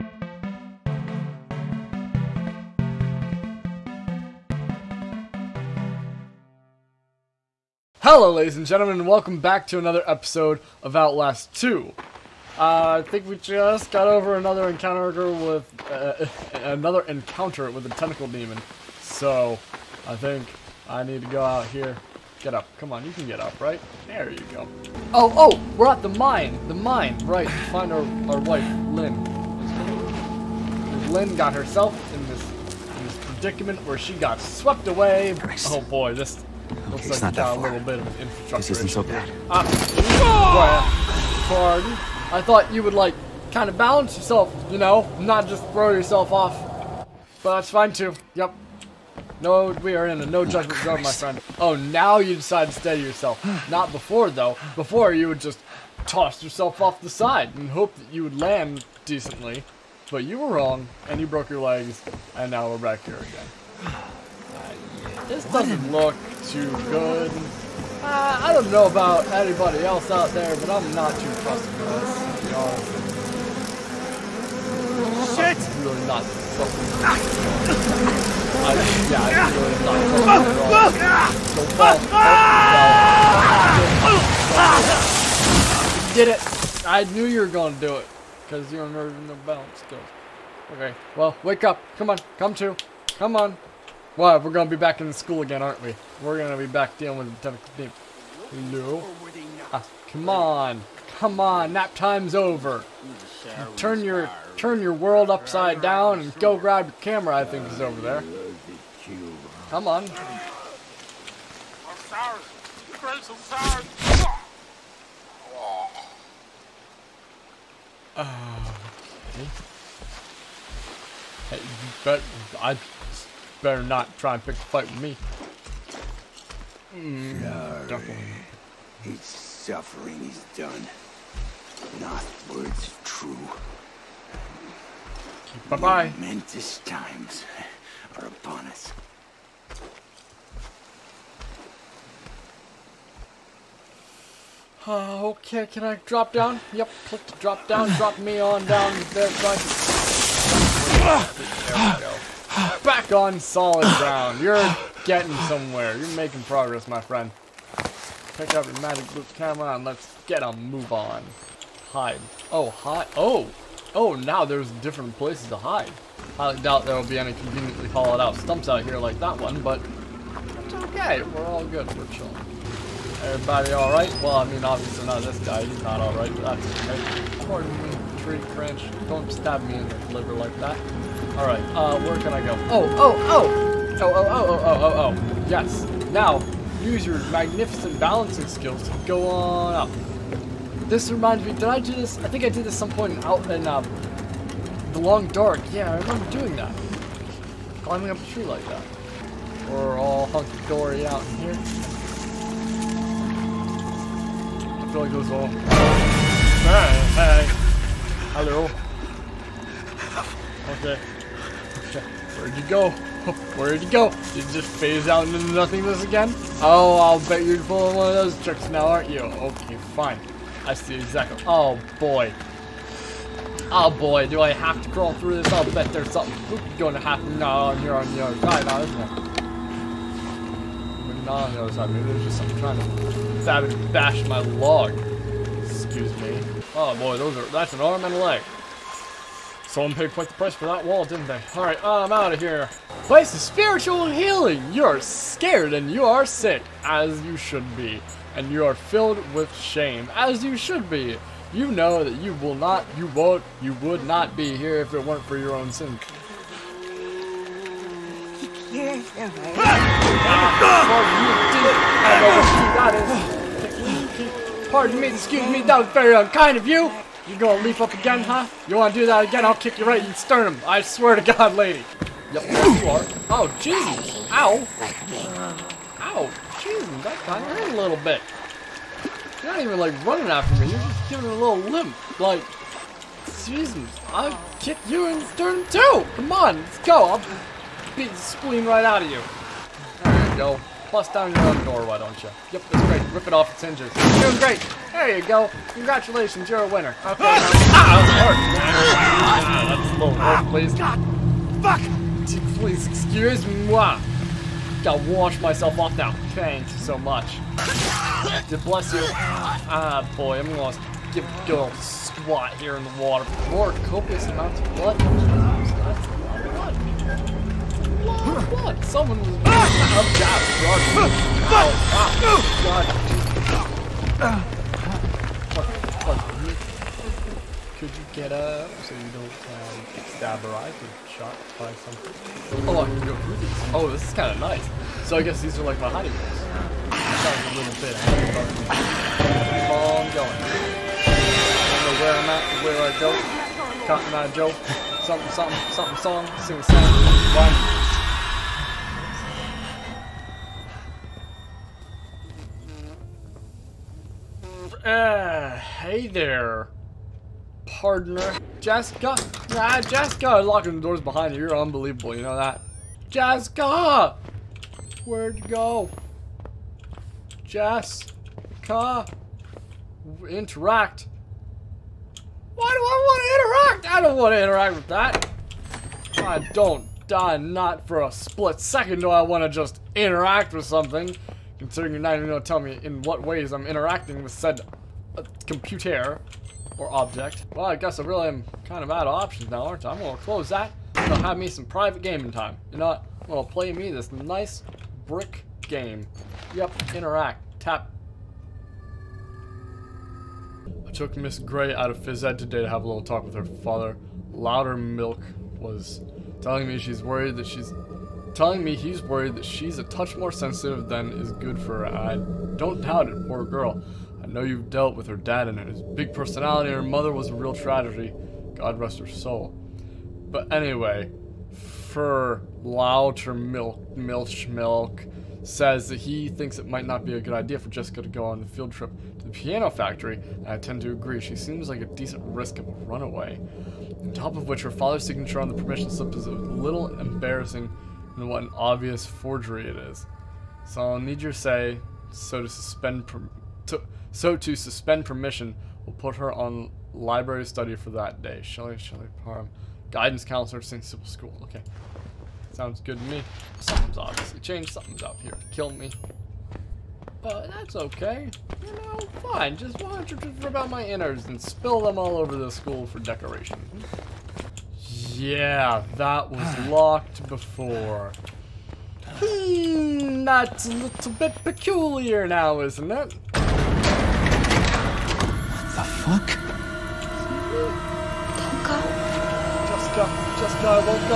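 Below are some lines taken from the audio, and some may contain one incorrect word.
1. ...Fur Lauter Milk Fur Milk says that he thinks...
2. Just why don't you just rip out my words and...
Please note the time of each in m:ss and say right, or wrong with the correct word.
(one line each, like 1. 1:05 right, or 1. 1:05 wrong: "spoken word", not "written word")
1. 7:01 wrong: "Milch", not "Fur"
2. 7:39 wrong: "innards", not "words".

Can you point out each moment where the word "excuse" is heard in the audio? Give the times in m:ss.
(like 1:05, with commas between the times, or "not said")
3:55, 4:25, 5:02.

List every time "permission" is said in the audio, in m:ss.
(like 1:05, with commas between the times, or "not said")
7:15, 7:25.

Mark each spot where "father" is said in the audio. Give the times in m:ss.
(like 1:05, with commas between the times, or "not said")
6:43, 7:14.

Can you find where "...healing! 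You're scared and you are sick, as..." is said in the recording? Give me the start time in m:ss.
4:04.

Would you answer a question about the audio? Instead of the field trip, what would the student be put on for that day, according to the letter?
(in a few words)
Library study.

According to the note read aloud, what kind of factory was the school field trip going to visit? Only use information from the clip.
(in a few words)
Piano factory.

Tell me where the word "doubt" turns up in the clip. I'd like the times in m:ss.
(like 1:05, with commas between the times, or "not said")
2:46, 6:52.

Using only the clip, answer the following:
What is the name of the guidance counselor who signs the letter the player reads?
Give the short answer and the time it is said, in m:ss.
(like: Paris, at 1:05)
Shelley Parham, at 7:28.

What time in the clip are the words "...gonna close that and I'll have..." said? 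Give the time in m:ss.
6:29.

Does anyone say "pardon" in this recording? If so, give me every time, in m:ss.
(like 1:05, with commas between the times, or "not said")
0:41, 2:57, 4:24.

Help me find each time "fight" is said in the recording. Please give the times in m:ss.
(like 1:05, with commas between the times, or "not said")
2:04.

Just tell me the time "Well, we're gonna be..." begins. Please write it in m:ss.
1:34.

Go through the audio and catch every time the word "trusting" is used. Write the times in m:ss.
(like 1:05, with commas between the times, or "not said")
1:11, 1:16, 1:20.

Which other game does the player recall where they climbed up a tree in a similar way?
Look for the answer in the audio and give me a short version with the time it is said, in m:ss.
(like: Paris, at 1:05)
The Long Dark, at 3:14.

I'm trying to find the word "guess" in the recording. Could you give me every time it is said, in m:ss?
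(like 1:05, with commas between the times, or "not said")
5:35, 6:27.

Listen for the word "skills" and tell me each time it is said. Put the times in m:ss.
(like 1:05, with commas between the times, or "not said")
1:29, 3:08.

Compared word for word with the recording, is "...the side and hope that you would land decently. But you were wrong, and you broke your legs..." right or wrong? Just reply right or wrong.
right.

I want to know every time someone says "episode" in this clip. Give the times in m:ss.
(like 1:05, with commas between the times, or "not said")
0:10.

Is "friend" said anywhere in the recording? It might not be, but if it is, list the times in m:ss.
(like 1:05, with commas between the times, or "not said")
0:51, 2:36.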